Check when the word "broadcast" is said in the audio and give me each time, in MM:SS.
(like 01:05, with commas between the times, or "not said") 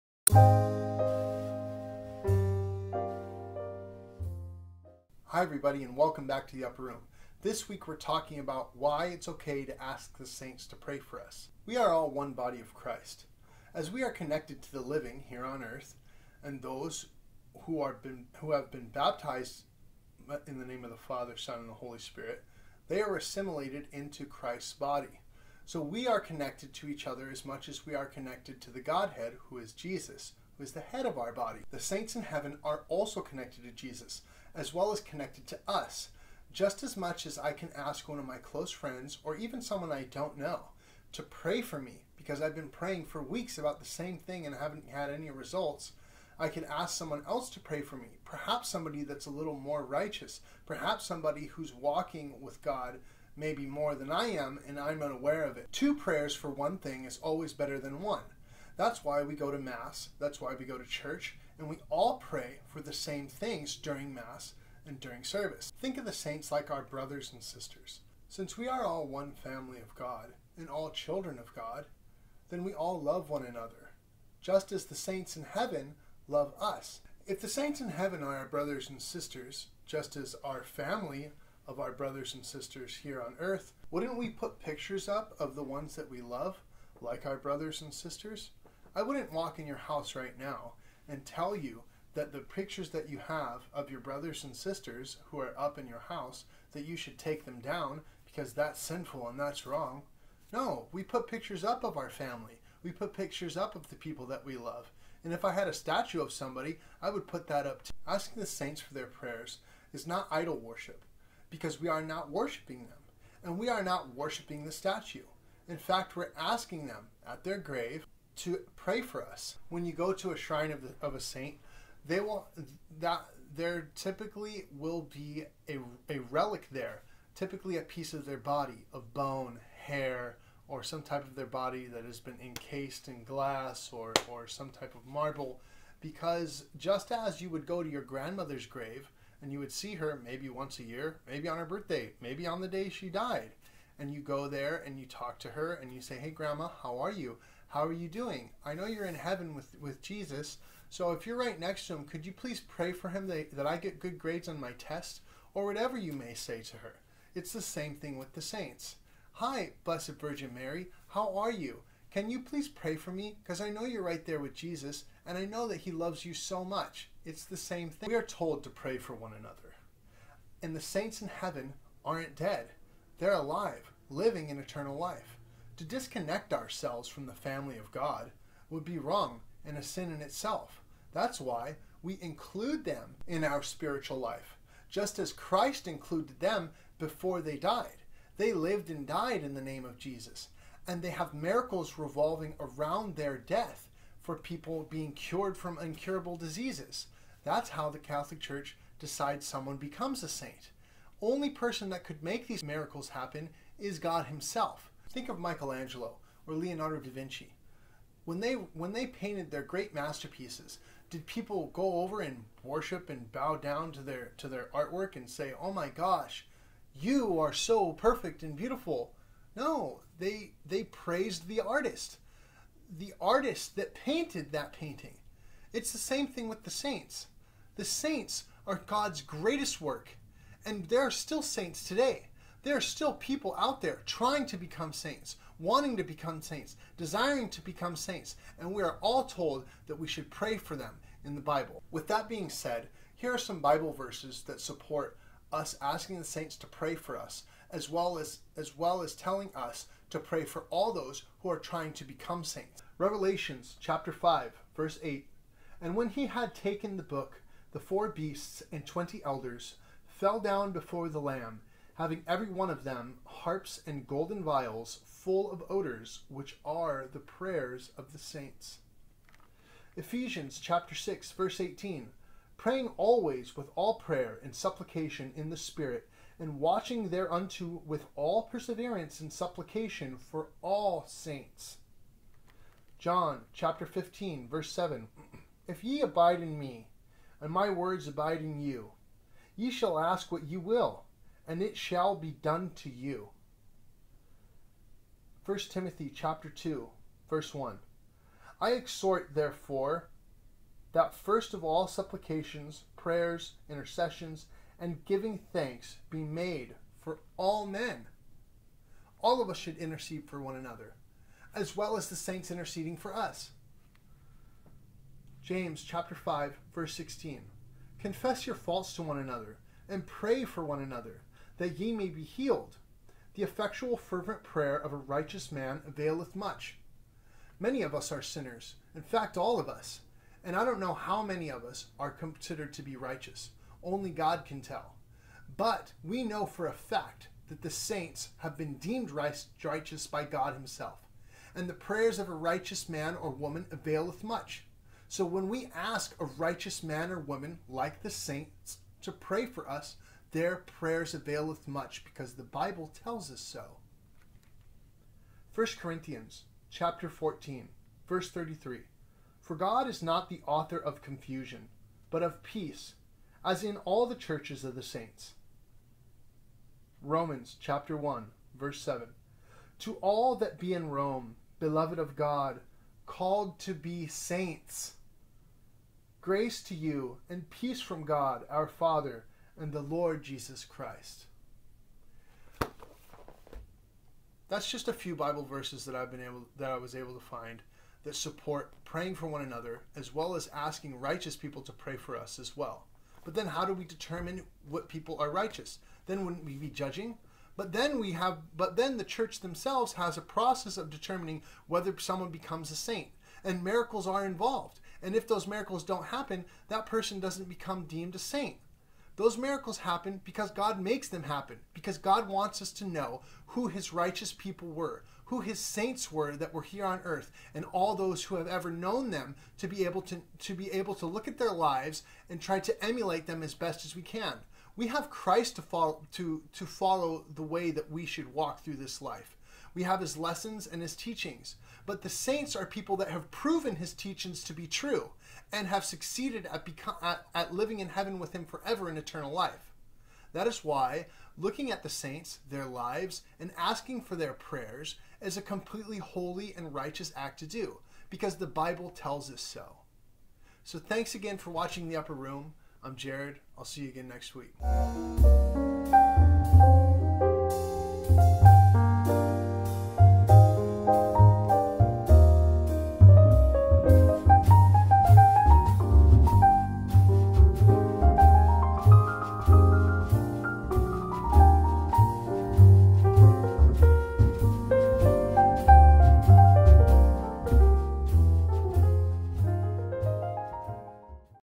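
not said.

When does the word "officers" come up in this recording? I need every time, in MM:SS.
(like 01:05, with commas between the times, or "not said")
not said.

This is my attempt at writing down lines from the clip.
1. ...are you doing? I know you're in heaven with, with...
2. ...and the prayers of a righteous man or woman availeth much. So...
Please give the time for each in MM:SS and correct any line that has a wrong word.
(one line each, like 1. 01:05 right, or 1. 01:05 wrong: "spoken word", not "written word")
1. 02:27 right
2. 05:41 right.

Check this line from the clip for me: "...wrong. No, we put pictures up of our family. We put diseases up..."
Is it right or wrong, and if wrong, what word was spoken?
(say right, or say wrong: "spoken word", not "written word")
wrong: "pictures", not "diseases".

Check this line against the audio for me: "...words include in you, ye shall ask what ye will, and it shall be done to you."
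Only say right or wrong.
wrong.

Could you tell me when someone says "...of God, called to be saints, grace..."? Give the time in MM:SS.
06:11.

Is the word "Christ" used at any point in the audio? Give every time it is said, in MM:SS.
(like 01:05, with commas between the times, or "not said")
00:12, 00:24, 03:05, 06:20, 07:05.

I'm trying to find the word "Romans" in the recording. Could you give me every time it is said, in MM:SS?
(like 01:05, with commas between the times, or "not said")
06:07.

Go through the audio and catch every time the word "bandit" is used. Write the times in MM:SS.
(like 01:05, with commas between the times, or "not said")
not said.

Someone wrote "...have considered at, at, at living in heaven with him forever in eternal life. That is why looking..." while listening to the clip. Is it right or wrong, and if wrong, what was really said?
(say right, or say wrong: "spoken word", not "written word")
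wrong: "succeeded", not "considered".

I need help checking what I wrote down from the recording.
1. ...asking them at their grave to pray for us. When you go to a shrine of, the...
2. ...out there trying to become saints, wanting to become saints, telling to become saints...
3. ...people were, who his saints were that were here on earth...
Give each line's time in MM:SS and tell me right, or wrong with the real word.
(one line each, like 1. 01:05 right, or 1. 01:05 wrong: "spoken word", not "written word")
1. 01:56 right
2. 03:53 wrong: "desiring", not "telling"
3. 06:54 right.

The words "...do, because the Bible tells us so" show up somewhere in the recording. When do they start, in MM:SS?
07:27.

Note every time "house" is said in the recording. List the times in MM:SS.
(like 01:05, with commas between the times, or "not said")
01:29, 01:35.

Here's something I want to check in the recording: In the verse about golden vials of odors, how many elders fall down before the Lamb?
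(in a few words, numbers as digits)
24.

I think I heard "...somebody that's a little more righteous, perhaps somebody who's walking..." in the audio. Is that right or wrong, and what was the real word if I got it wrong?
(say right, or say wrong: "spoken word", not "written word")
right.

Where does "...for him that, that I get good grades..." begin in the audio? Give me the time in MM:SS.
02:32.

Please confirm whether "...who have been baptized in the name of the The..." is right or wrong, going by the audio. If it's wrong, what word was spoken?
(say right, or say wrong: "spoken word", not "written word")
wrong: "Father", not "The".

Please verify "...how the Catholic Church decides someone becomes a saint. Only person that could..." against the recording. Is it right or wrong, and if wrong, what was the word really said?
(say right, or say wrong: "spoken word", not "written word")
right.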